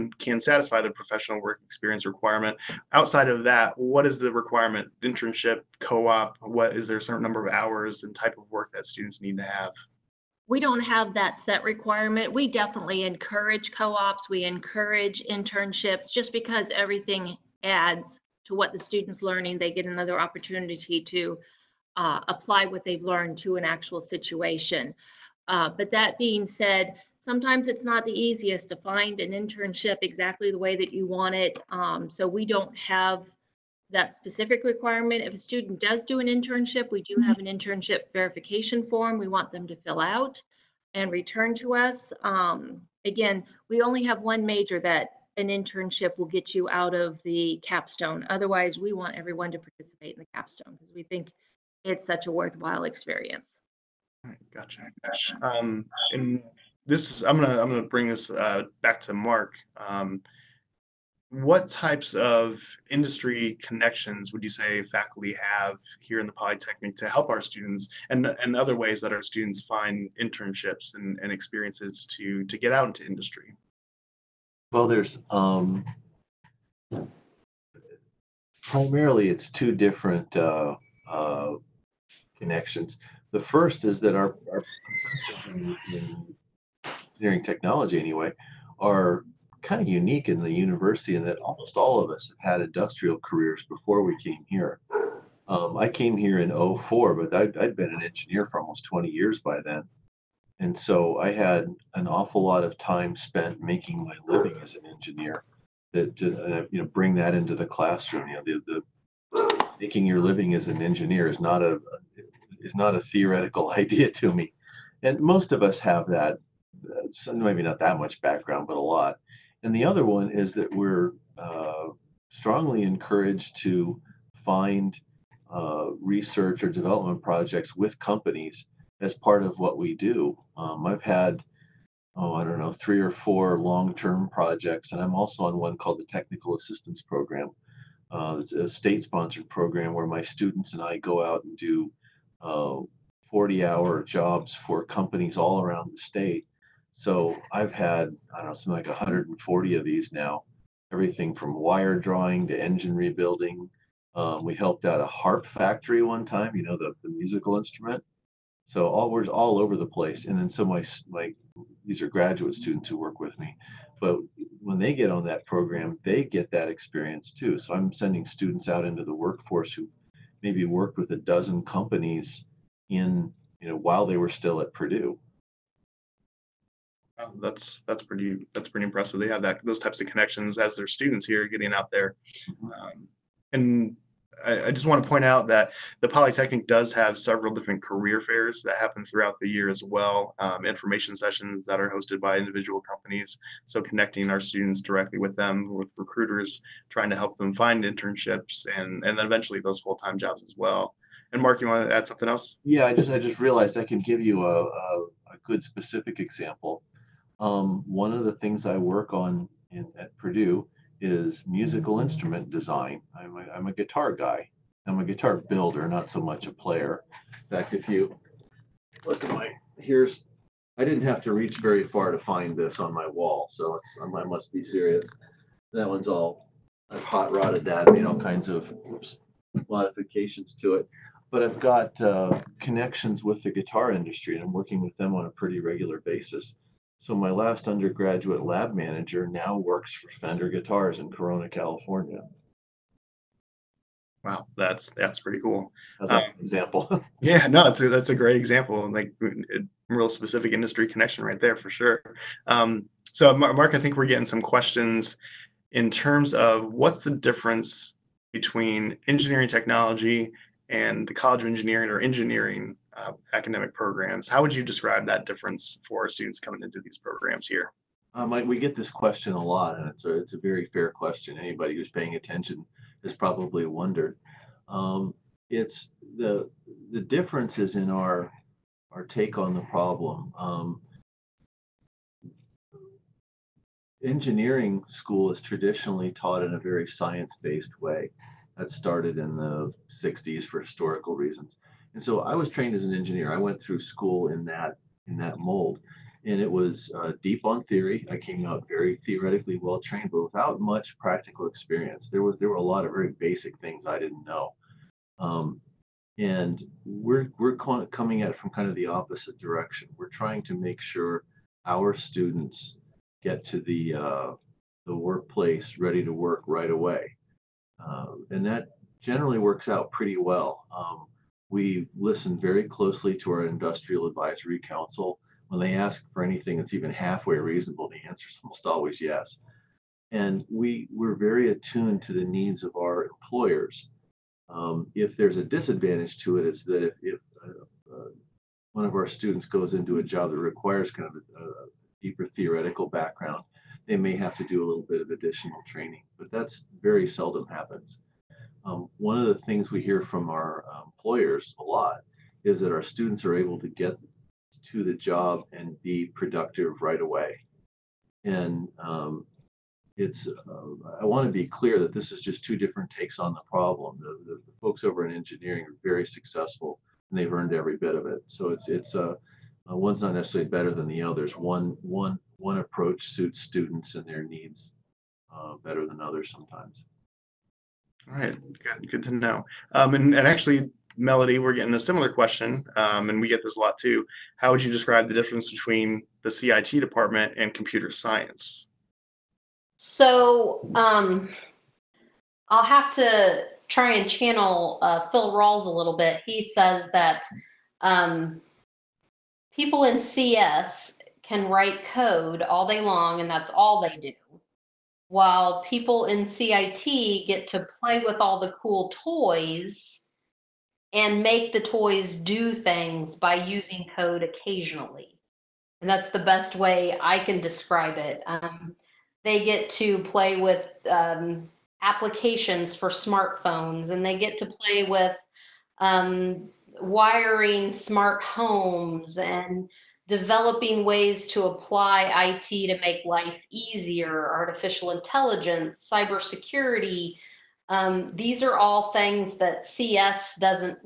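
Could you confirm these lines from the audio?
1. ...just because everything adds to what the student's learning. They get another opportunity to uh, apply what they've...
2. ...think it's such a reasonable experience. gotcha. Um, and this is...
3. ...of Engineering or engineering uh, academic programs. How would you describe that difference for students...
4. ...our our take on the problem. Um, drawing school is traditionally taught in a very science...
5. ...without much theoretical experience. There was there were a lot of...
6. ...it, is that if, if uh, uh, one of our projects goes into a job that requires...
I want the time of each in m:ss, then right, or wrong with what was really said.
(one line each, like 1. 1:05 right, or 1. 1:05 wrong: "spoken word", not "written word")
1. 0:16 right
2. 0:51 wrong: "worthwhile", not "reasonable"
3. 4:21 right
4. 4:37 wrong: "engineering", not "drawing"
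5. 5:00 wrong: "practical", not "theoretical"
6. 5:36 wrong: "students", not "projects".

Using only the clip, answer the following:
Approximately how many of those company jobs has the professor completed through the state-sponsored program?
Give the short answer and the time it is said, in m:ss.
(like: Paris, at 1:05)
140, at 2:28.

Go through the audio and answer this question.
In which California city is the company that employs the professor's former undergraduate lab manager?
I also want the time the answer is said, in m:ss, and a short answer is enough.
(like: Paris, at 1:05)
Corona, at 4:01.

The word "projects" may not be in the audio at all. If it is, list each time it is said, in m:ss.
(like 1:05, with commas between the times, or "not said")
2:07, 2:14.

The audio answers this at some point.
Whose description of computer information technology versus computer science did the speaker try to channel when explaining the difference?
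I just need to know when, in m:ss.
6:35.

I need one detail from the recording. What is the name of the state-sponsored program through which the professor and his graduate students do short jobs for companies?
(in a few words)
Technical Assistance Program.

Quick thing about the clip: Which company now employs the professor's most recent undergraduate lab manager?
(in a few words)
Fender.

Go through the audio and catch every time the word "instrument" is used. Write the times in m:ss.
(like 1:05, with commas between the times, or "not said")
2:37, 3:32.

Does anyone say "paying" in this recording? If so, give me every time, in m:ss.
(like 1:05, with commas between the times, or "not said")
4:31.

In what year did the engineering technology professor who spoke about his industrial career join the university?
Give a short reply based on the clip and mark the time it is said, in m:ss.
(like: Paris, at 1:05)
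2004, at 1:36.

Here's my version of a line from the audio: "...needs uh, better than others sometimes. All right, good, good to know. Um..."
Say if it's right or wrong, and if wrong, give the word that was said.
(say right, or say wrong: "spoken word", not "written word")
right.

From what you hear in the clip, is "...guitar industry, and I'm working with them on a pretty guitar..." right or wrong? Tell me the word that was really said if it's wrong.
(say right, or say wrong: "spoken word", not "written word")
wrong: "regular", not "guitar".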